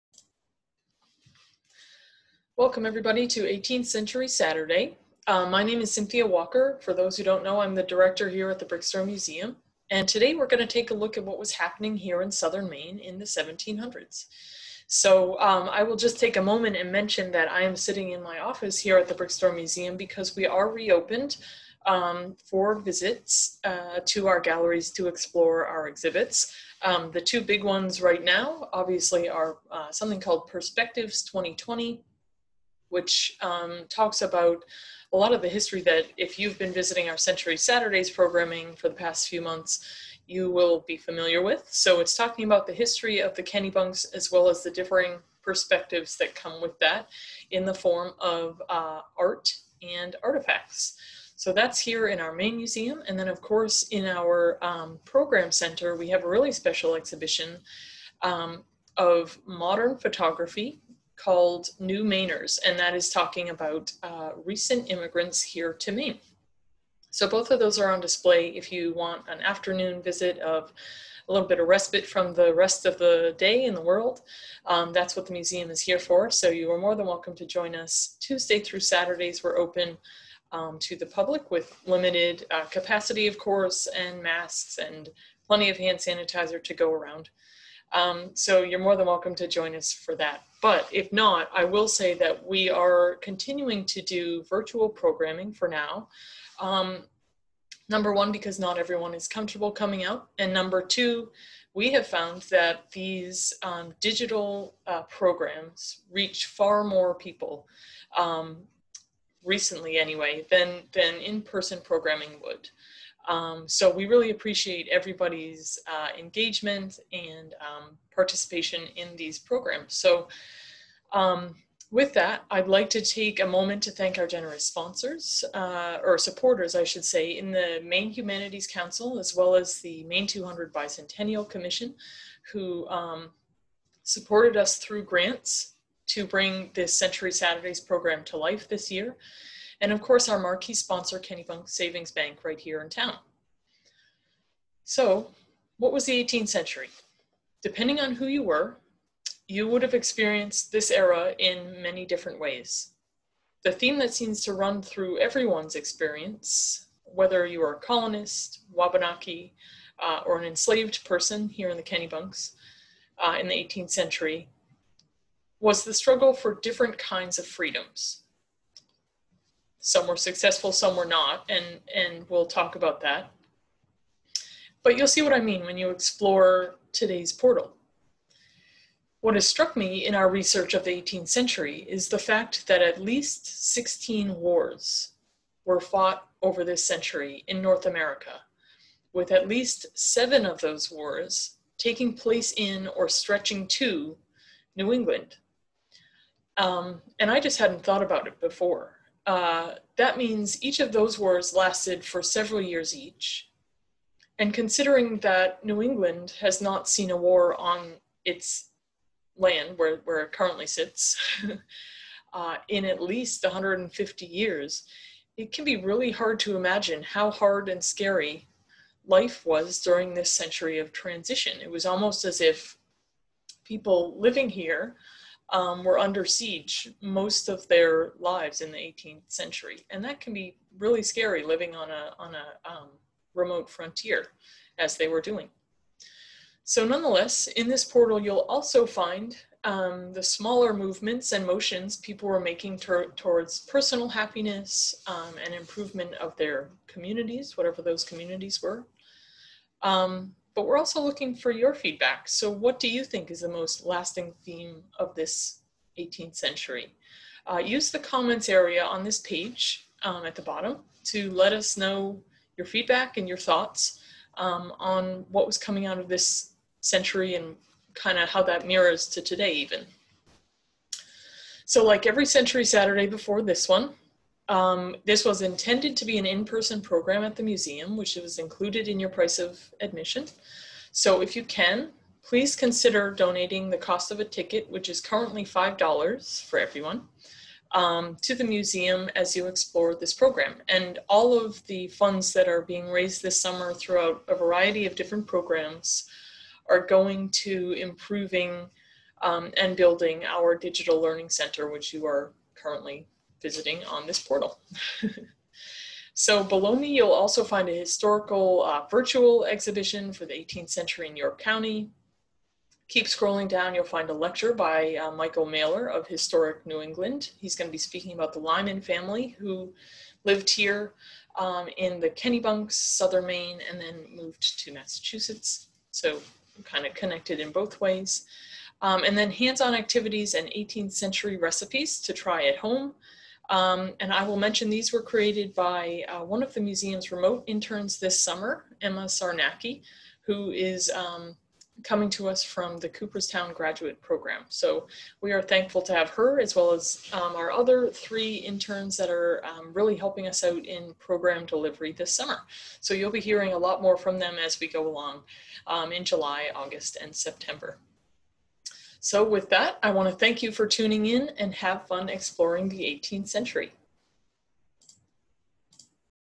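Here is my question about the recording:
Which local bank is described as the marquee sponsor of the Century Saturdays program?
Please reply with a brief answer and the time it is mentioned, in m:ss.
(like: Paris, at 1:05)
Kennebunk Savings Bank, at 2:21.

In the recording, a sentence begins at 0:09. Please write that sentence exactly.
And today we're going to take a look at what was happening here in southern Maine in the 1700s.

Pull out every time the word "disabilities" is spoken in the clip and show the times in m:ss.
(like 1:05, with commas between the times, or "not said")
not said.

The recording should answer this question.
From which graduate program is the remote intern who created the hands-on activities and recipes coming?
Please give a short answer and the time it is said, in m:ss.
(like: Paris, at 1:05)
Cooperstown graduate program, at 5:42.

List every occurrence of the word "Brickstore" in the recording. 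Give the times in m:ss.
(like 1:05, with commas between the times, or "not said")
0:08, 0:19.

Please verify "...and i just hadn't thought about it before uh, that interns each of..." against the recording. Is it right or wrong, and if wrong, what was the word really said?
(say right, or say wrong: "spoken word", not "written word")
wrong: "means", not "interns".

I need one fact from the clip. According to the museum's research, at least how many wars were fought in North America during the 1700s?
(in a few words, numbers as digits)
16.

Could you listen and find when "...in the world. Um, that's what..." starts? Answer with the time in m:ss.
1:13.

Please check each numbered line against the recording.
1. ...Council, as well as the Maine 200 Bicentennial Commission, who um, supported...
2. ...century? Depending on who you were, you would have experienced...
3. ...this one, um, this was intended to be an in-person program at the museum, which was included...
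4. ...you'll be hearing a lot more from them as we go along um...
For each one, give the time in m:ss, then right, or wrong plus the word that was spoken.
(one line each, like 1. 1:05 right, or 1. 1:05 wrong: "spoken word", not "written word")
1. 2:08 right
2. 2:26 right
3. 4:33 right
4. 5:52 right.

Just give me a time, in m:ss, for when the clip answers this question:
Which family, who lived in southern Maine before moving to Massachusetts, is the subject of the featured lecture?
5:18.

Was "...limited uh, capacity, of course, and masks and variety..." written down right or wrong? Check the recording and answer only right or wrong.
wrong.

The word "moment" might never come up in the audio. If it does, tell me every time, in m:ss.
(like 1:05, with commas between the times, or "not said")
0:16, 2:03.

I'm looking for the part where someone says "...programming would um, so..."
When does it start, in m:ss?
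1:51.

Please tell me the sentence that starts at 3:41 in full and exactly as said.
It was almost as if people living here um, were under siege most of their lives in the 18th century.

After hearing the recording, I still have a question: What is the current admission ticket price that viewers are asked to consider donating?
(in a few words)
$5.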